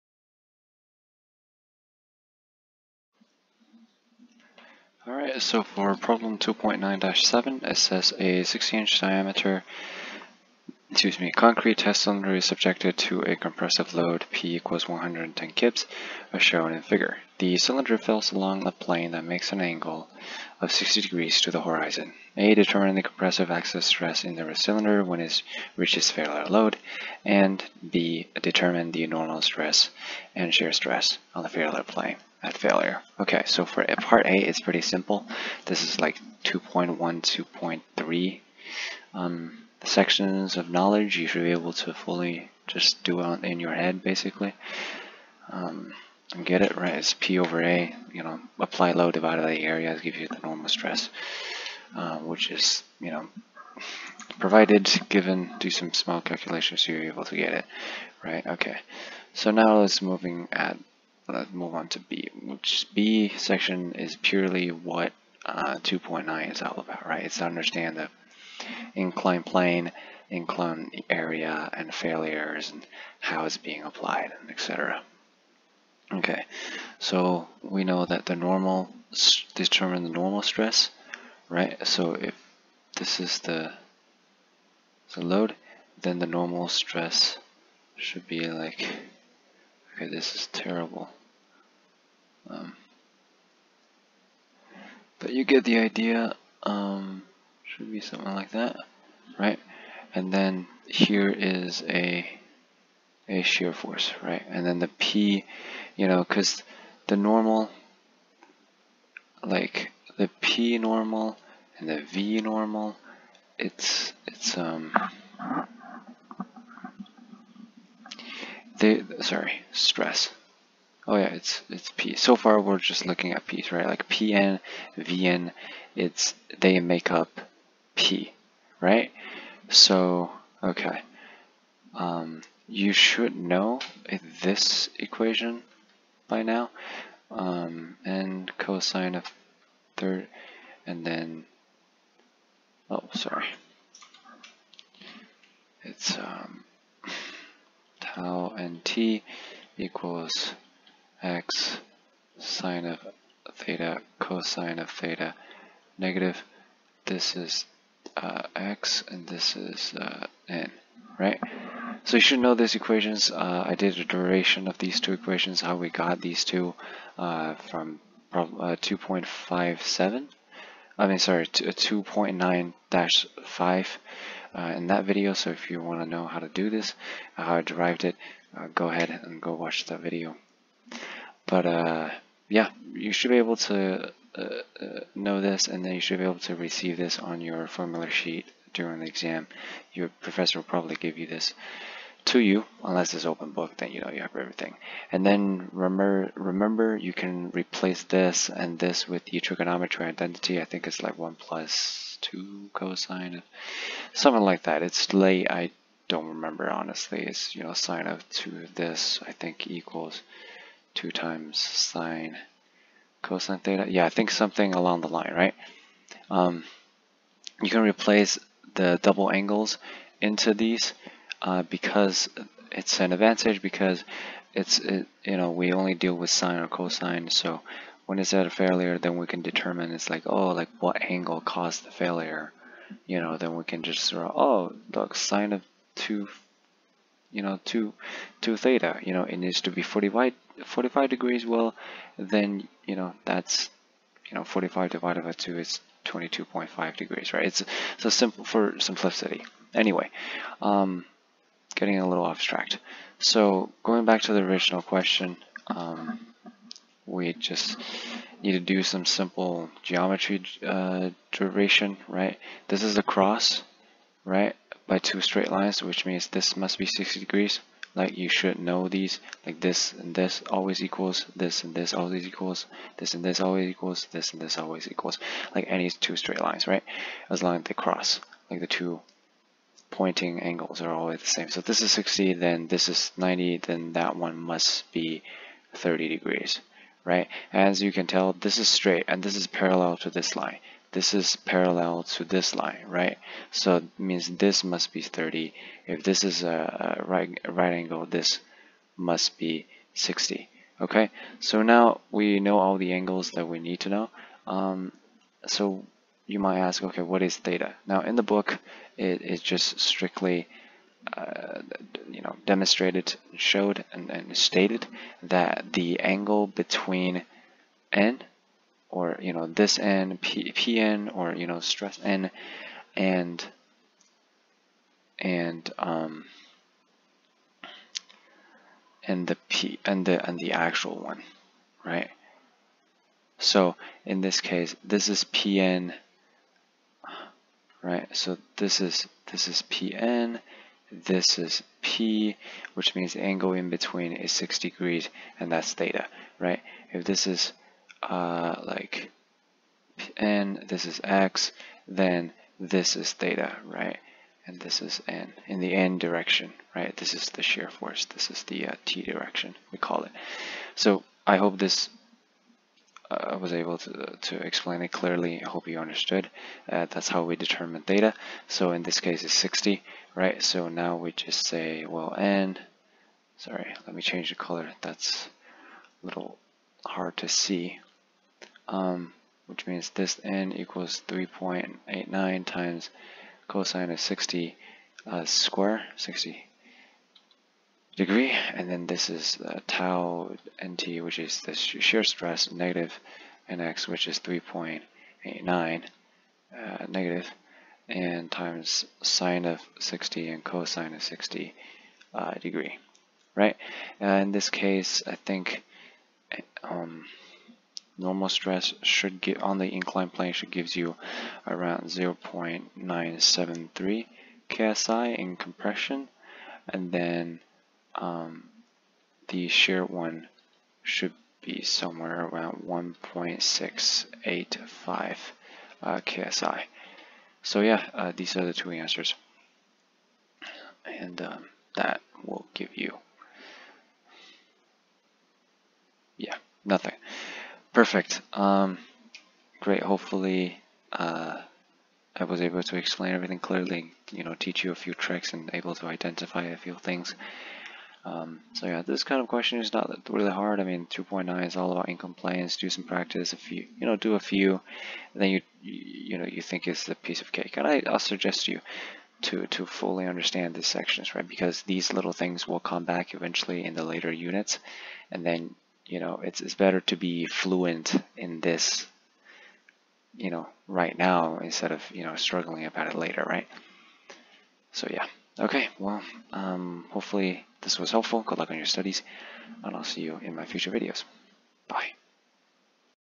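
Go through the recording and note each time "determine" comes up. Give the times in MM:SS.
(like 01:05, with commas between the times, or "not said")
00:22, 00:28, 01:19, 03:49, 06:07.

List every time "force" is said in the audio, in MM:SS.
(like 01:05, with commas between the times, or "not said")
01:43, 05:57.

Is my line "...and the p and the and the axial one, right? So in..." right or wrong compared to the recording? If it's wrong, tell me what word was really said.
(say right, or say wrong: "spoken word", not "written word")
wrong: "actual", not "axial".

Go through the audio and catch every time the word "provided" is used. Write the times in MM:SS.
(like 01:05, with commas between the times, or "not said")
00:54.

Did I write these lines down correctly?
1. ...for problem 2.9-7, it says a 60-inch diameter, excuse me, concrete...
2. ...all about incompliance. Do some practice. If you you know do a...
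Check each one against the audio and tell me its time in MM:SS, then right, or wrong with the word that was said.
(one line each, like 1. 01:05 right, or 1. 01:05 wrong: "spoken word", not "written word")
1. 00:05 right
2. 07:31 right.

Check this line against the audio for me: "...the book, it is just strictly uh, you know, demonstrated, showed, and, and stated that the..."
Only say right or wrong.
right.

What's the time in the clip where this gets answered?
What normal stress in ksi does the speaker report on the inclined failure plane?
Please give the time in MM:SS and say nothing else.
06:51.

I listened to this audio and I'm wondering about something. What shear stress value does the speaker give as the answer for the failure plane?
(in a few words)
1.685 ksi.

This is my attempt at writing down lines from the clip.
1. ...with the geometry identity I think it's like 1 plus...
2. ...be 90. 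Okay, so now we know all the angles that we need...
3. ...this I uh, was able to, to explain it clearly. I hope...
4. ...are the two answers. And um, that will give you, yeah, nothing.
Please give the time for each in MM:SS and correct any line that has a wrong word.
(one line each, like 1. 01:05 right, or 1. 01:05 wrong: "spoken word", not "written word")
1. 03:19 wrong: "trigonometry", not "geometry"
2. 04:59 wrong: "60", not "90"
3. 06:01 right
4. 07:08 right.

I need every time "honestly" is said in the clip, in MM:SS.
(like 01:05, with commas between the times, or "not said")
03:26.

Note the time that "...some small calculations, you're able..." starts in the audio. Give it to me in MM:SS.
00:55.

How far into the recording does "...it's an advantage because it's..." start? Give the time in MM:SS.
03:42.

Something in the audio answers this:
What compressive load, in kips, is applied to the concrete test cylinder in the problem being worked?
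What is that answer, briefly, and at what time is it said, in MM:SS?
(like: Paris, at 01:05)
110 kips, at 00:14.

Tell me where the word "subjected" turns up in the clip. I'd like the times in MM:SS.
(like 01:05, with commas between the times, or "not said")
00:12.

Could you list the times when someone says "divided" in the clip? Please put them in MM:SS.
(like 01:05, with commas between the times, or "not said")
00:49, 04:04.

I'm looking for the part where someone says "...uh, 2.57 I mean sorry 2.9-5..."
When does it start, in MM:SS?
02:48.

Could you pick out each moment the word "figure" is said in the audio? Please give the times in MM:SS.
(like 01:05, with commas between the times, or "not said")
00:16.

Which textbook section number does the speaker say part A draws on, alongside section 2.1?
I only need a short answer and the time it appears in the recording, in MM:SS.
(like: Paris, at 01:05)
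2.3, at 00:36.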